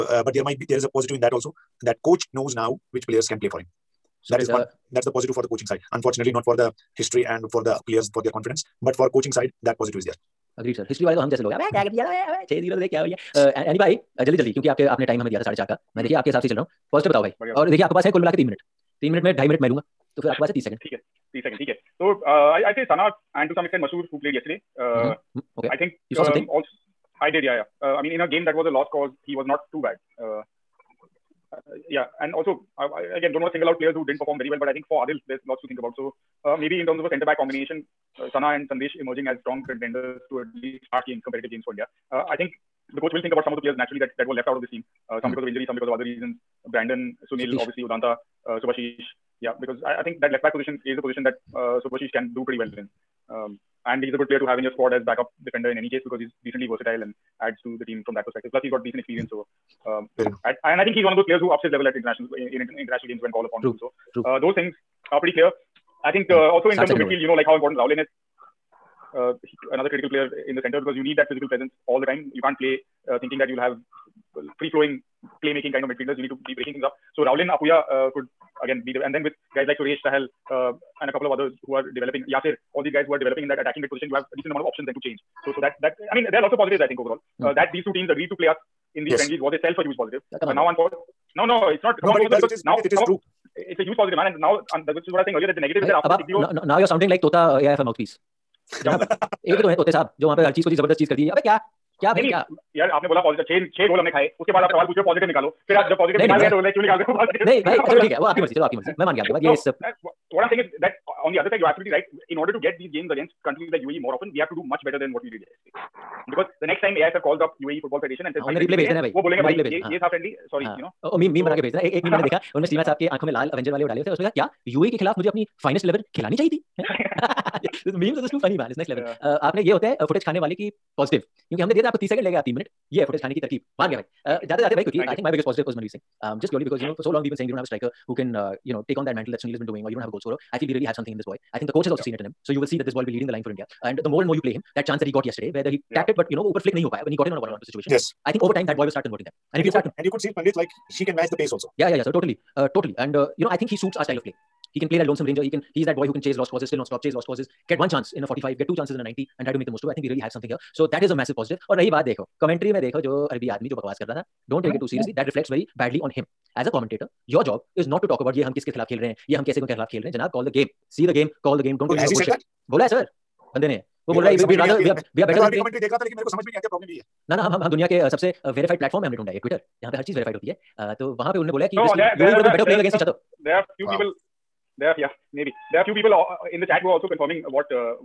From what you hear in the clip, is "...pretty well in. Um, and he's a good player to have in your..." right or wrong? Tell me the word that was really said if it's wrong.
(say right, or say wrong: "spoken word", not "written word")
right.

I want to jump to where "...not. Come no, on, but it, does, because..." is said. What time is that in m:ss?
1:31.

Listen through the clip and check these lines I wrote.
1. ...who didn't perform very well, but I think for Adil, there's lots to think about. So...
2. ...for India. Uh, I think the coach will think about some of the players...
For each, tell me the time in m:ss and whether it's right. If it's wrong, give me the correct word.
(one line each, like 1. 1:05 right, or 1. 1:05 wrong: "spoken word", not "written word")
1. 0:33 right
2. 0:41 right.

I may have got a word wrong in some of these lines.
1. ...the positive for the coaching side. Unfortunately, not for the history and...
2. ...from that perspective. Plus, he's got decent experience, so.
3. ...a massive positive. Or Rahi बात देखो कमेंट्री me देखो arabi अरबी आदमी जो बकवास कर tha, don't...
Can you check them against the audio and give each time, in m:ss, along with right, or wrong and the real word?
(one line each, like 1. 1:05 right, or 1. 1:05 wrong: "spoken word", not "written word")
1. 0:05 right
2. 0:58 right
3. 2:41 right.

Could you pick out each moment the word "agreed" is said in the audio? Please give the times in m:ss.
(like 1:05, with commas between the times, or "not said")
0:10, 1:28.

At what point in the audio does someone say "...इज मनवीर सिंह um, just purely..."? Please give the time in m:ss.
2:15.